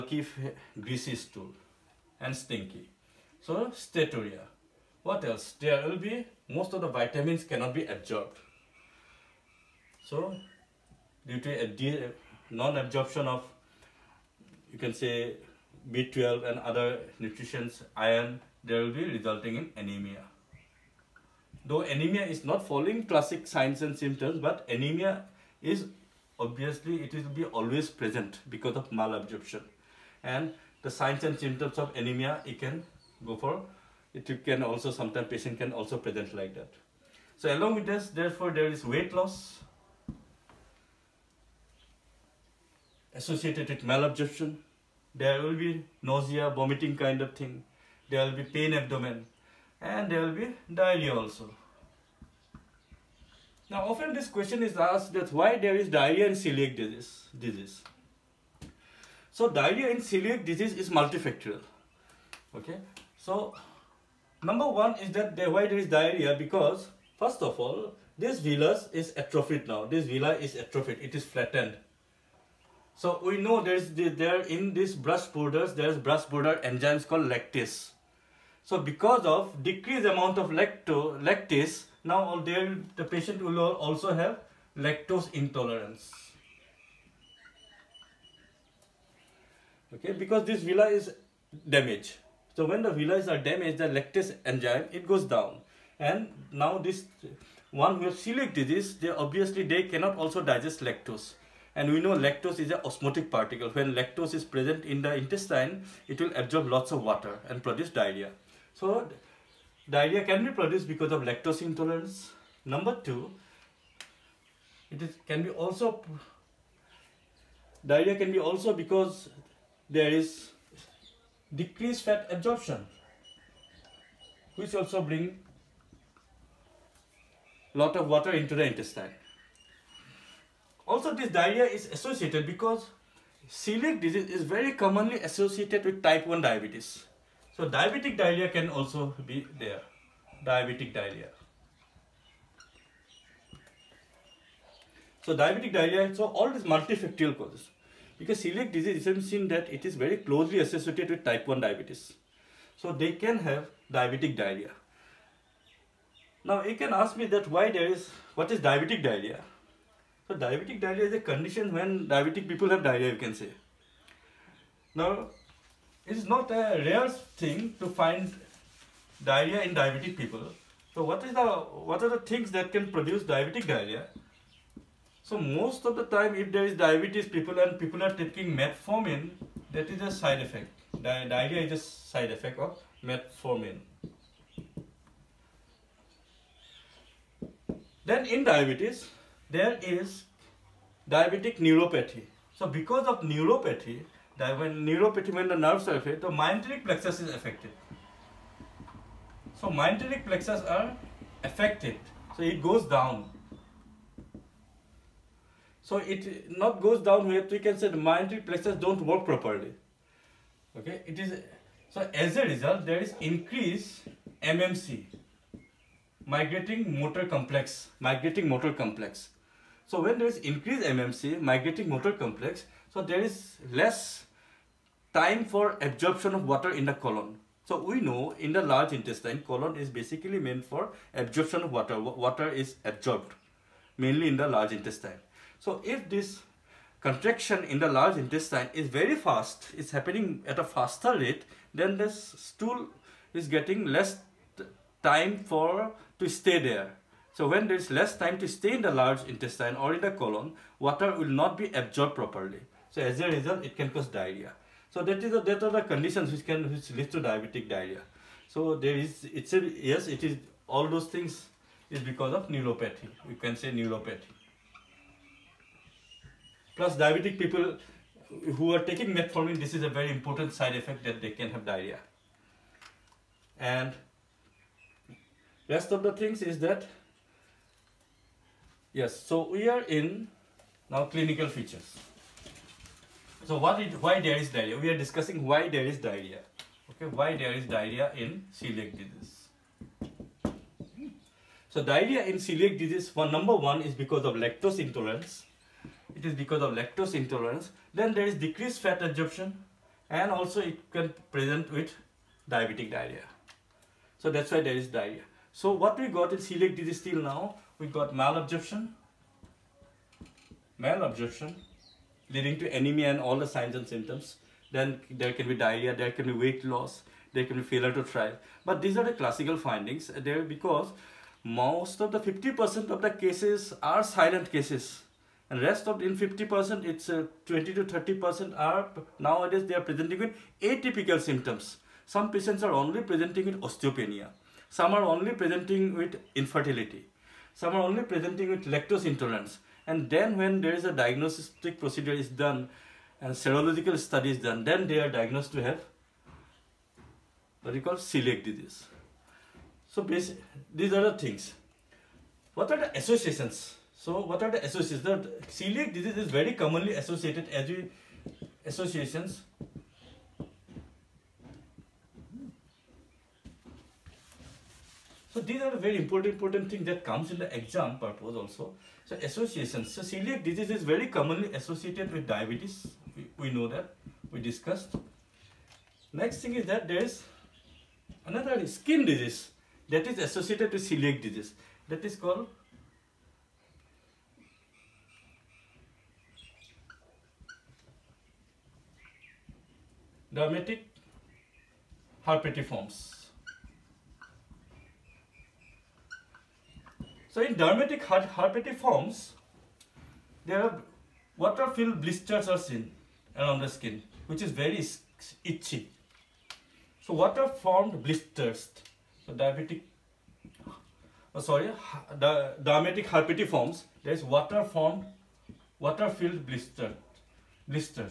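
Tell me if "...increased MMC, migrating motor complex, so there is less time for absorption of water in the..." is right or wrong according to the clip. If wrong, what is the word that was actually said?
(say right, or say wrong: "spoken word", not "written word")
right.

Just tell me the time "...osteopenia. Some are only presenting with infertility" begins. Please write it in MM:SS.
05:33.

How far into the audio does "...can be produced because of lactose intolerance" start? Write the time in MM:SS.
01:50.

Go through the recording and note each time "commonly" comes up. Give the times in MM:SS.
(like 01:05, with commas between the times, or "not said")
02:14, 05:56, 06:11.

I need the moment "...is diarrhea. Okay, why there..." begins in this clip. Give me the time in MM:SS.
04:45.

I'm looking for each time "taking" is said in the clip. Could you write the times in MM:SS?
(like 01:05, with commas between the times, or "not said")
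02:58, 04:28.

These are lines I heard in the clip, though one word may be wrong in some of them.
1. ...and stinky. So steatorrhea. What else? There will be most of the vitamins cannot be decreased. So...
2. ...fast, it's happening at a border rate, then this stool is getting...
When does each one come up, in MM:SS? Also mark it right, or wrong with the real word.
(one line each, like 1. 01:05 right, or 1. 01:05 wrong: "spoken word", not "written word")
1. 00:02 wrong: "absorbed", not "decreased"
2. 03:59 wrong: "faster", not "border".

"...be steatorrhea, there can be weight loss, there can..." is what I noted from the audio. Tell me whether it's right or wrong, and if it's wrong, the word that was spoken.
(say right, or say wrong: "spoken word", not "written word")
wrong: "diarrhea", not "steatorrhea".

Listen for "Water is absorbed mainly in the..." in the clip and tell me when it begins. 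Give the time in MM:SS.
03:51.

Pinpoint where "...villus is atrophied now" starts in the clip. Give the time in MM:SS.
01:08.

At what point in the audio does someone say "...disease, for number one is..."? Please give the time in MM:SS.
04:52.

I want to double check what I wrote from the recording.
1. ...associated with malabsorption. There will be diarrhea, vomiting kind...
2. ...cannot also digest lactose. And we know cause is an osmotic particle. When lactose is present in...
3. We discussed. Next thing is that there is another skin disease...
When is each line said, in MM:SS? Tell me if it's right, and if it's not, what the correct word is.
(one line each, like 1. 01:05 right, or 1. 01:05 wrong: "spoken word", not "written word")
1. 00:43 wrong: "nausea", not "diarrhea"
2. 01:39 wrong: "lactose", not "cause"
3. 06:14 right.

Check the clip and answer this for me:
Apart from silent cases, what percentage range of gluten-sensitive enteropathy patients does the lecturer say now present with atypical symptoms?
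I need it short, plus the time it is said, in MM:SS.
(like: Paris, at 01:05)
20 to 30%, at 05:27.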